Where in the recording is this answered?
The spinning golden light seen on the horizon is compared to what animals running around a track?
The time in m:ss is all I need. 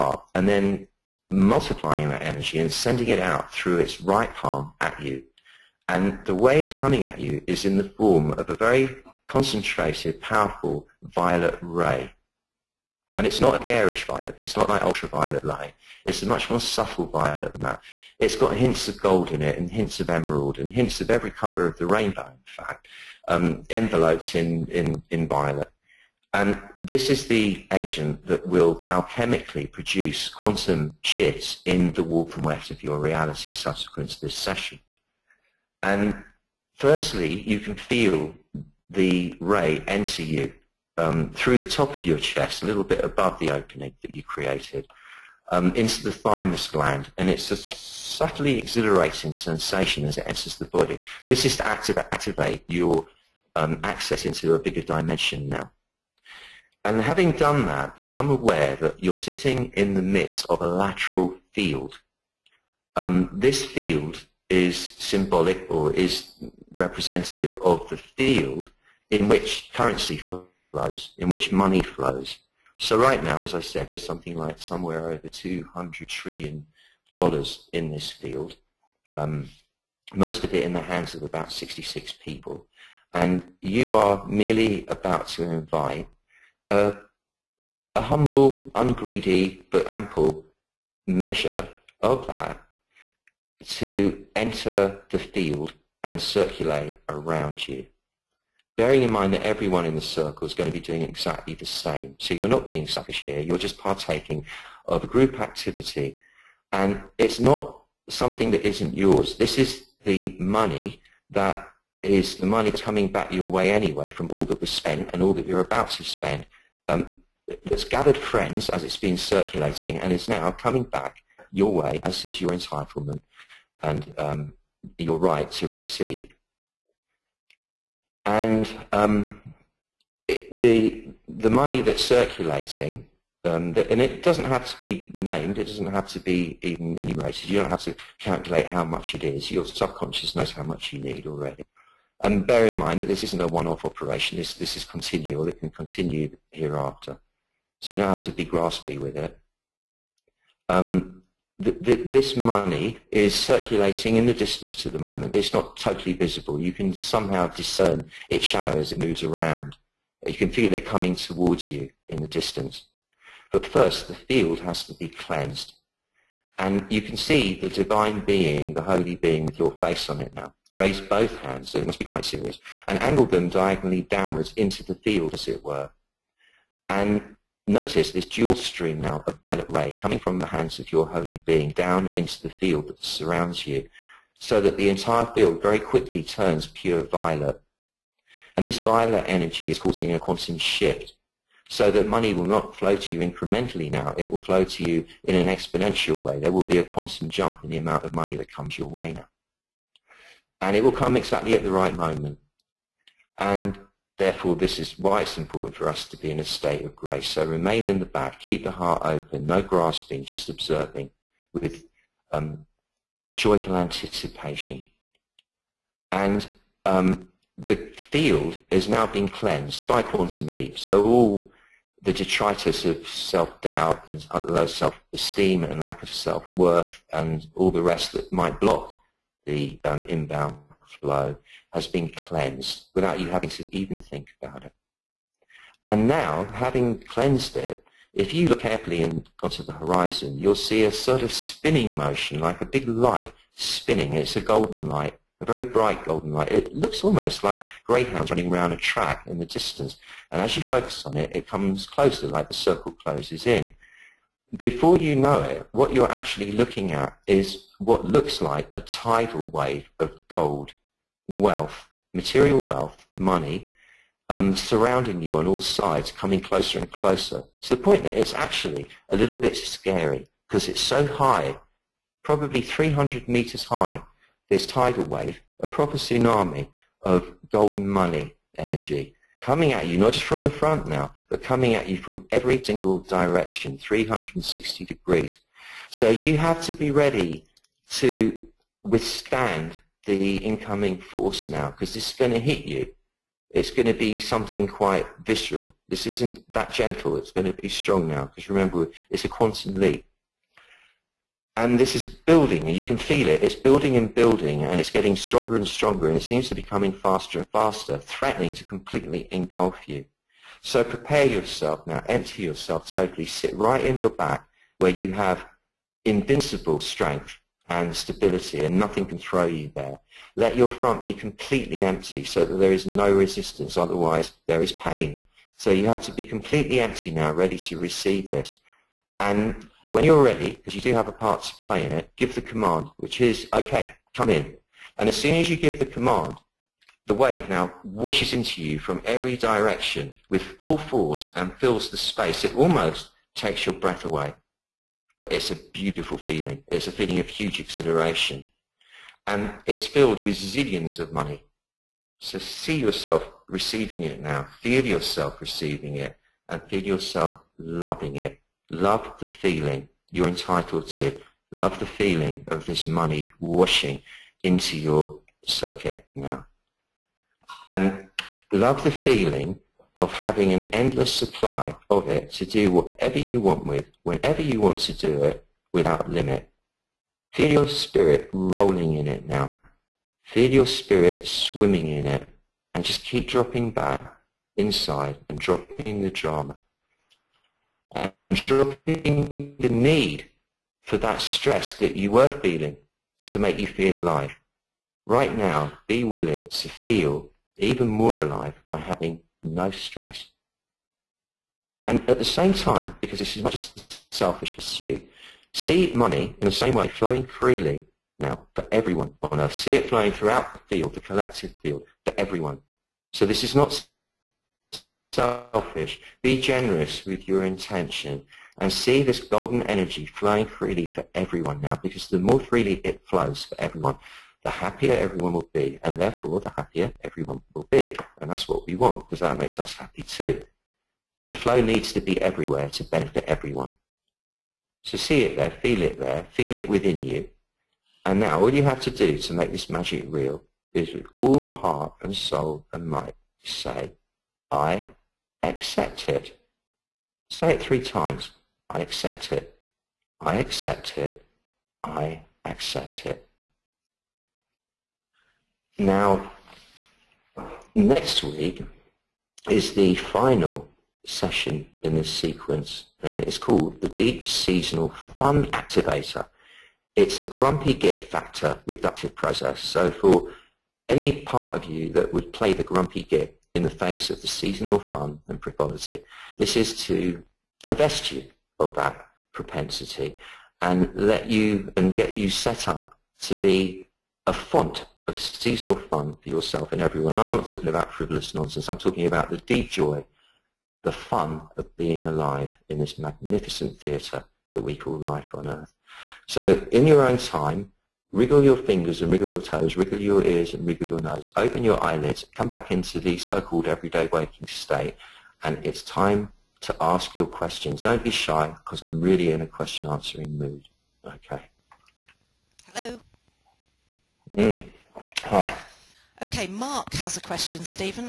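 4:07.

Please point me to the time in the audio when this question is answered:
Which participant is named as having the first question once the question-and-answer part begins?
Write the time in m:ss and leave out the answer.
8:36.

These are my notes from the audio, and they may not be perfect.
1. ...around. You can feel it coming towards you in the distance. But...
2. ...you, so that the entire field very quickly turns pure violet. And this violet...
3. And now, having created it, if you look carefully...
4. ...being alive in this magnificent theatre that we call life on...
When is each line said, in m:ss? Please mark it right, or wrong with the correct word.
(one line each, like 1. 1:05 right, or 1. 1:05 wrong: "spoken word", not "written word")
1. 2:39 right
2. 3:03 right
3. 3:55 wrong: "cleansed", not "created"
4. 8:11 right.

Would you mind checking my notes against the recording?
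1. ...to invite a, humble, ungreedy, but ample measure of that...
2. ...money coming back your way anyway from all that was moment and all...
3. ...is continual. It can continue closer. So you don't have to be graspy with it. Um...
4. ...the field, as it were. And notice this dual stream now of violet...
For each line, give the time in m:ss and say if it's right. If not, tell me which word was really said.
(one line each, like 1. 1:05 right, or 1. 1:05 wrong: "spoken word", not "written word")
1. 1:25 right
2. 1:52 wrong: "spent", not "moment"
3. 2:24 wrong: "hereafter", not "closer"
4. 2:54 right.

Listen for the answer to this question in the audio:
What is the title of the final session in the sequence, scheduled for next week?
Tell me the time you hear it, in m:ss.
7:43.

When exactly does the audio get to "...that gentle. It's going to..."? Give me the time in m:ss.
4:56.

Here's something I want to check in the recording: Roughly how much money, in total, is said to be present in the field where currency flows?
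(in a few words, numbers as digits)
over 200 trillion dollars.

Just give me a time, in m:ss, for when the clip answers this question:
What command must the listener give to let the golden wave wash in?
5:33.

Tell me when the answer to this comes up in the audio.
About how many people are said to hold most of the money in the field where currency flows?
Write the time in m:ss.
1:21.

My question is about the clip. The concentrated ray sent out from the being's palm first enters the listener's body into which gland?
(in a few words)
thymus gland.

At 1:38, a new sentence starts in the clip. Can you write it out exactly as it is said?
Bearing in mind that everyone in the circle is going to be doing exactly the same.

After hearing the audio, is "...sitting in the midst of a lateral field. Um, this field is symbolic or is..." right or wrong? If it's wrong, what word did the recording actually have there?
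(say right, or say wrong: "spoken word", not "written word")
right.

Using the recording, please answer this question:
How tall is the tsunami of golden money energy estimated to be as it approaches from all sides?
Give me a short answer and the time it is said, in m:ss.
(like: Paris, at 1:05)
300 meters, at 4:32.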